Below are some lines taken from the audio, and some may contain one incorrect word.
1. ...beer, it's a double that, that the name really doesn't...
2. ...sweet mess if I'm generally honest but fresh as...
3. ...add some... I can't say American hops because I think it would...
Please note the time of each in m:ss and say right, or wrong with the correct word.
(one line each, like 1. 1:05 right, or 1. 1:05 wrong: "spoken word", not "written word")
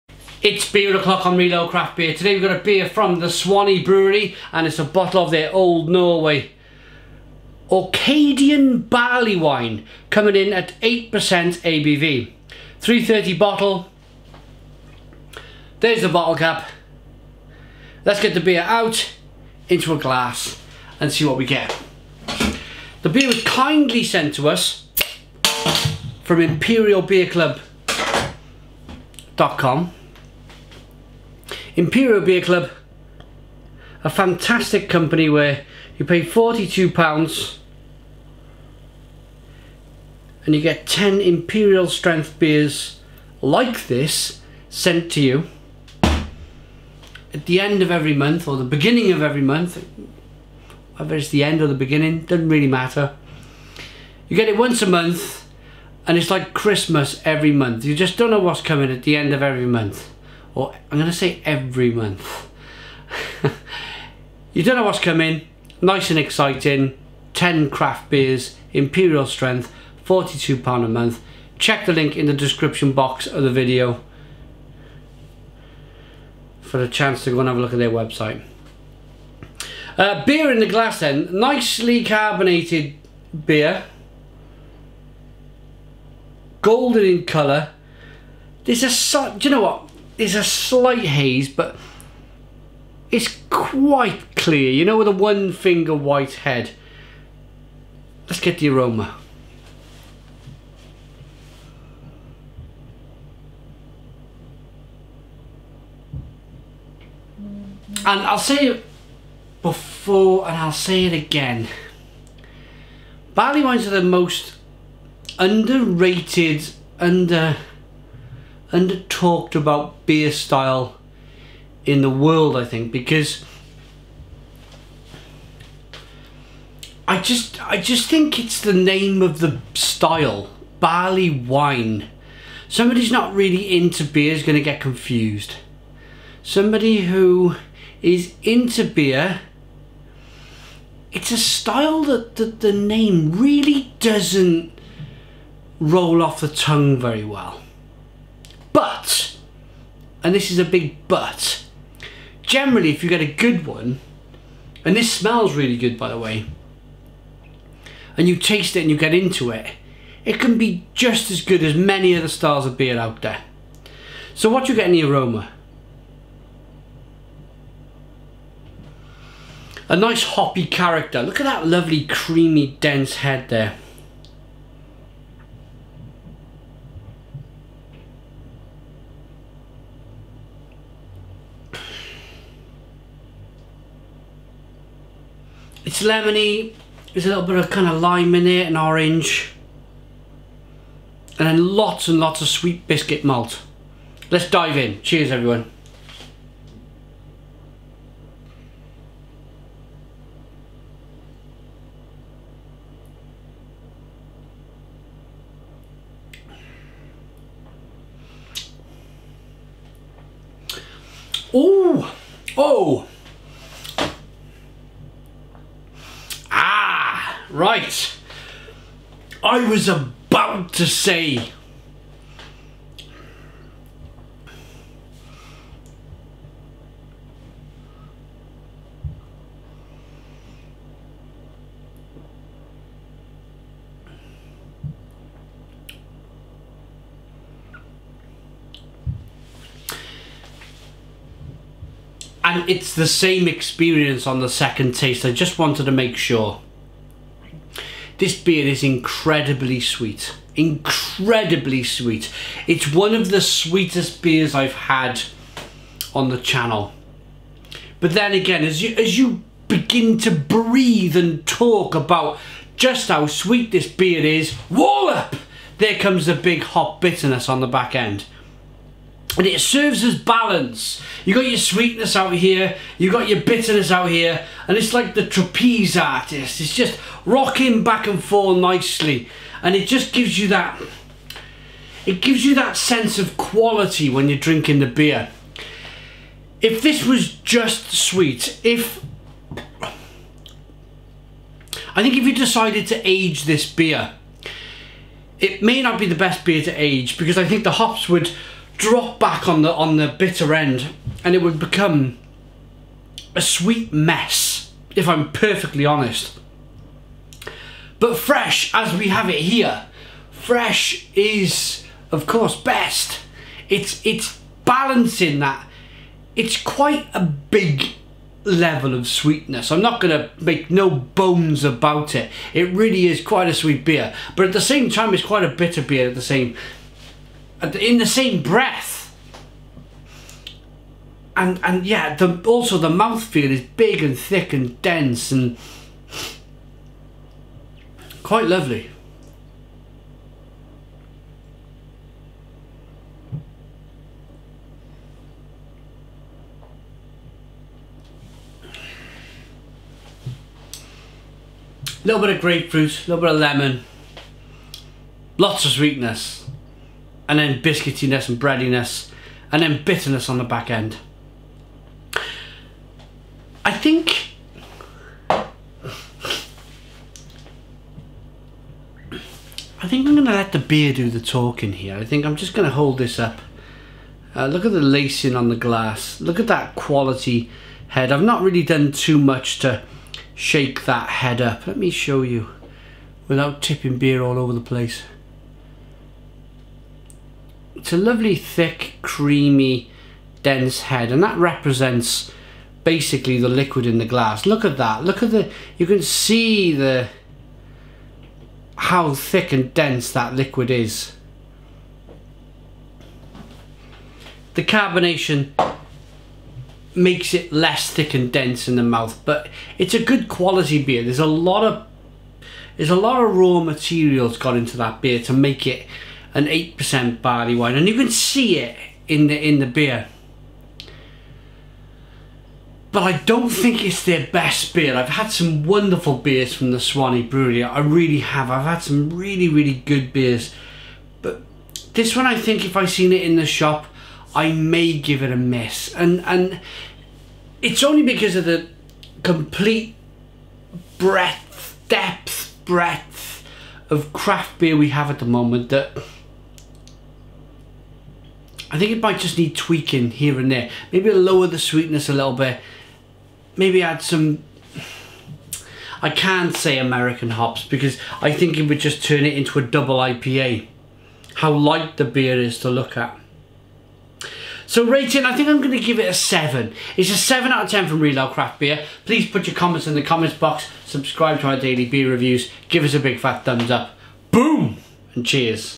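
1. 2:18 wrong: "style", not "double"
2. 5:03 wrong: "perfectly", not "generally"
3. 7:33 right.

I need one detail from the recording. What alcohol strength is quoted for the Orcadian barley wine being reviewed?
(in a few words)
8%.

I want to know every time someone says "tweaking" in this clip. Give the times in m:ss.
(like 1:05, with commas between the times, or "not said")
7:29.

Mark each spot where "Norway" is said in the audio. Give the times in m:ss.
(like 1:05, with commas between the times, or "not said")
0:05.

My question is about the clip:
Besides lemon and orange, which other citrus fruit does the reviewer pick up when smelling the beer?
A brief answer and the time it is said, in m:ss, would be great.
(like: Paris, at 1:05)
Lime, at 3:08.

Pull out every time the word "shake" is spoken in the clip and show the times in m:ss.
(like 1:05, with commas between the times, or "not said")
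6:20.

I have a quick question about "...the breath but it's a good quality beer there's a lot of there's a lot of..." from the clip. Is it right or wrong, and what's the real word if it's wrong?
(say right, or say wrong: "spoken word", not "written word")
wrong: "mouth", not "breath".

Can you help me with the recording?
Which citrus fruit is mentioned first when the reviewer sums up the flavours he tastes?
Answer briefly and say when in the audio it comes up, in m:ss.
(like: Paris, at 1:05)
Grapefruit, at 5:52.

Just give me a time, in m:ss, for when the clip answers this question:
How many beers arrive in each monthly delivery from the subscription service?
0:40.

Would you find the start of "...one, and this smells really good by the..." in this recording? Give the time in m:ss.
2:33.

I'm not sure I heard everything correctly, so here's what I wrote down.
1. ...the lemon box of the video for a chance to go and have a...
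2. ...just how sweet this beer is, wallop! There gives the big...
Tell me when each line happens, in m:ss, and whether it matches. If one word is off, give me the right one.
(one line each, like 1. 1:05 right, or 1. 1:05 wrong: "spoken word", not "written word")
1. 1:12 wrong: "description", not "lemon"
2. 4:22 wrong: "comes", not "gives".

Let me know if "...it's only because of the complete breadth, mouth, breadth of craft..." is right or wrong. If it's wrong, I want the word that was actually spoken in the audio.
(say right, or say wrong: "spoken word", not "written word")
wrong: "depth", not "mouth".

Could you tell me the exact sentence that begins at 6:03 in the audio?
I think I think I'm going to let the beer do the talking here.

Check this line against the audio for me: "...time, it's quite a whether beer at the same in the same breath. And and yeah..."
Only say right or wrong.
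wrong.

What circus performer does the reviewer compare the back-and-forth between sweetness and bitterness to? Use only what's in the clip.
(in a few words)
Trapeze artist.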